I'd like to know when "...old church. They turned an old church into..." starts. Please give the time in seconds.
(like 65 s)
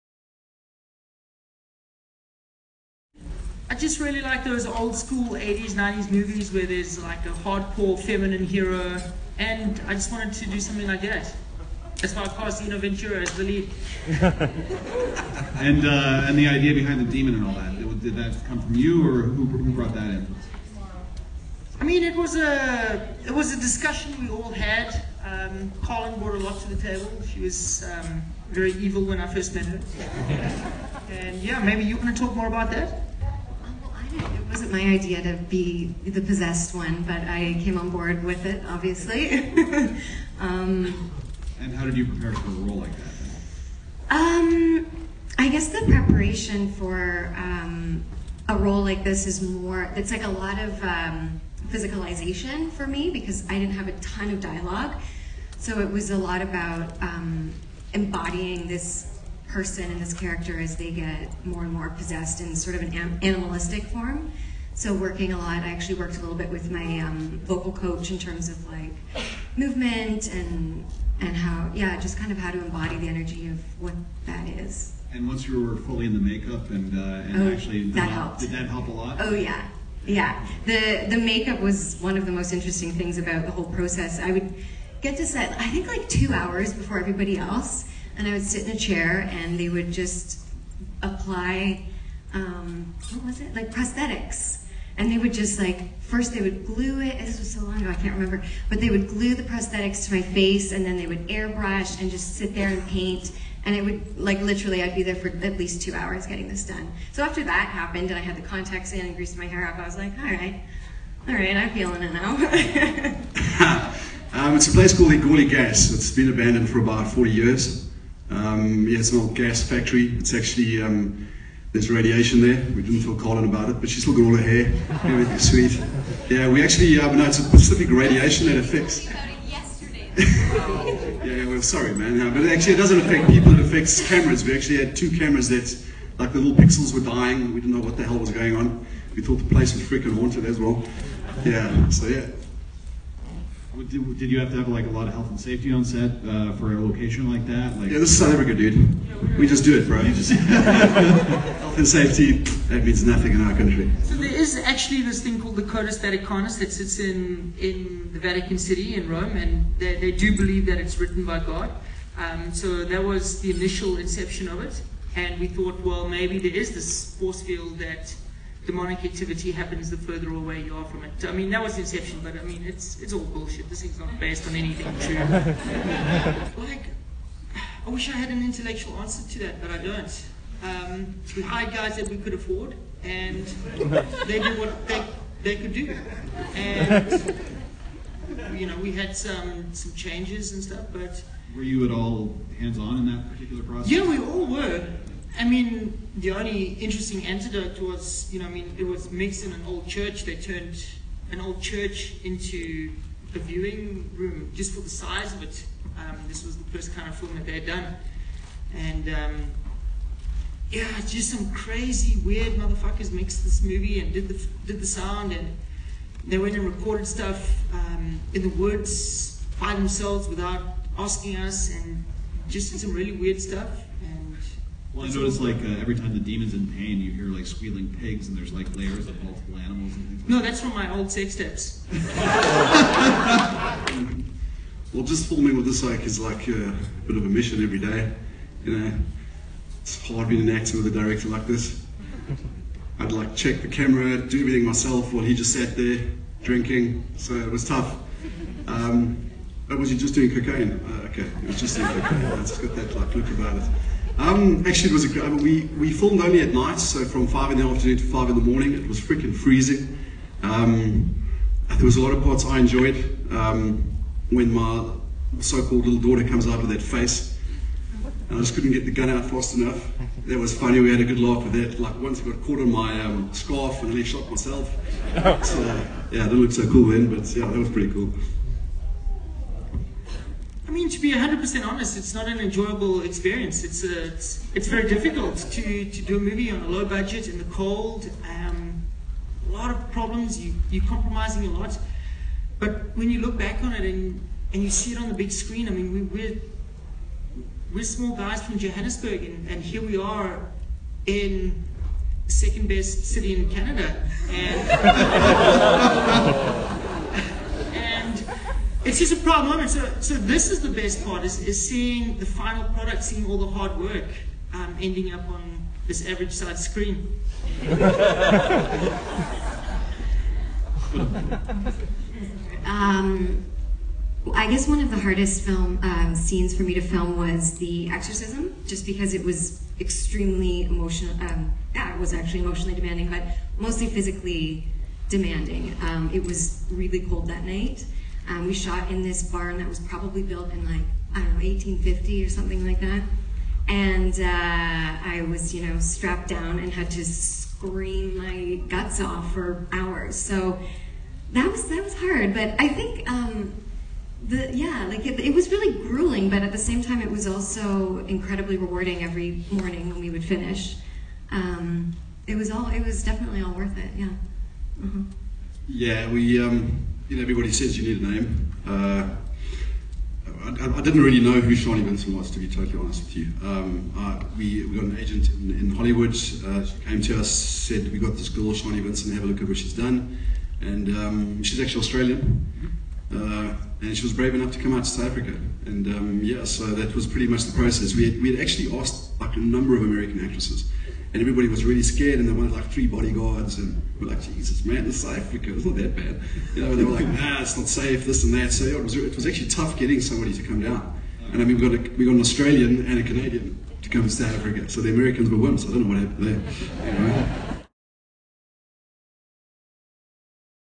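199 s.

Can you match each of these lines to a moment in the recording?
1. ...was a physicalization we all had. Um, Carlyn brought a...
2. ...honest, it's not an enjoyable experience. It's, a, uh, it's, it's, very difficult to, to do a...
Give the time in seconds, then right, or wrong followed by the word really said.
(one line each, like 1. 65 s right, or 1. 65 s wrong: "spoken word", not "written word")
1. 23 s wrong: "discussion", not "physicalization"
2. 281 s right.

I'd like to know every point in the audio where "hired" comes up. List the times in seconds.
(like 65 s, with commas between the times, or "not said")
181 s.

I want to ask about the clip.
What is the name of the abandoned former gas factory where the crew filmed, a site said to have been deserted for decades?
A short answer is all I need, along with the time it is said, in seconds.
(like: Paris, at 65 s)
Egoli Gas, at 115 s.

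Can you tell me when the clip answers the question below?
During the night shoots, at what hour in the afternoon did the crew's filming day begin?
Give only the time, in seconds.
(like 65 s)
257 s.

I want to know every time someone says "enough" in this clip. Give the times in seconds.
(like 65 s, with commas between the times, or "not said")
269 s, 384 s.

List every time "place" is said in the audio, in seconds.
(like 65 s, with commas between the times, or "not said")
114 s, 139 s.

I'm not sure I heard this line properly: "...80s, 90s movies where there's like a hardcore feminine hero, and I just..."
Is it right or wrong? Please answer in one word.
right.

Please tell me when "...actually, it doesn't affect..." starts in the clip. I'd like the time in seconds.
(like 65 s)
132 s.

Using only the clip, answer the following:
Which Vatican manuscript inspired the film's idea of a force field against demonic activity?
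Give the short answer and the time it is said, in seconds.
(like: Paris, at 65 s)
Codex Vaticanus, at 155 s.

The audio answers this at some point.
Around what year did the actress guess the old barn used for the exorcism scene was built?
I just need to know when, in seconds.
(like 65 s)
341 s.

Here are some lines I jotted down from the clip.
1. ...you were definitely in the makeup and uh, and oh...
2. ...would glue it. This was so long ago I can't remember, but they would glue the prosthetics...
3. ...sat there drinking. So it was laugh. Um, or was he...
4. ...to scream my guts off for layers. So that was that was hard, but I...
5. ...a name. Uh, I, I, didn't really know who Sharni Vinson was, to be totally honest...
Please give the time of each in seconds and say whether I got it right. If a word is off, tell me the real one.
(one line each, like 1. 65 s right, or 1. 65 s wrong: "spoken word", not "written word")
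1. 75 s wrong: "fully", not "definitely"
2. 96 s right
3. 245 s wrong: "tough", not "laugh"
4. 346 s wrong: "hours", not "layers"
5. 368 s right.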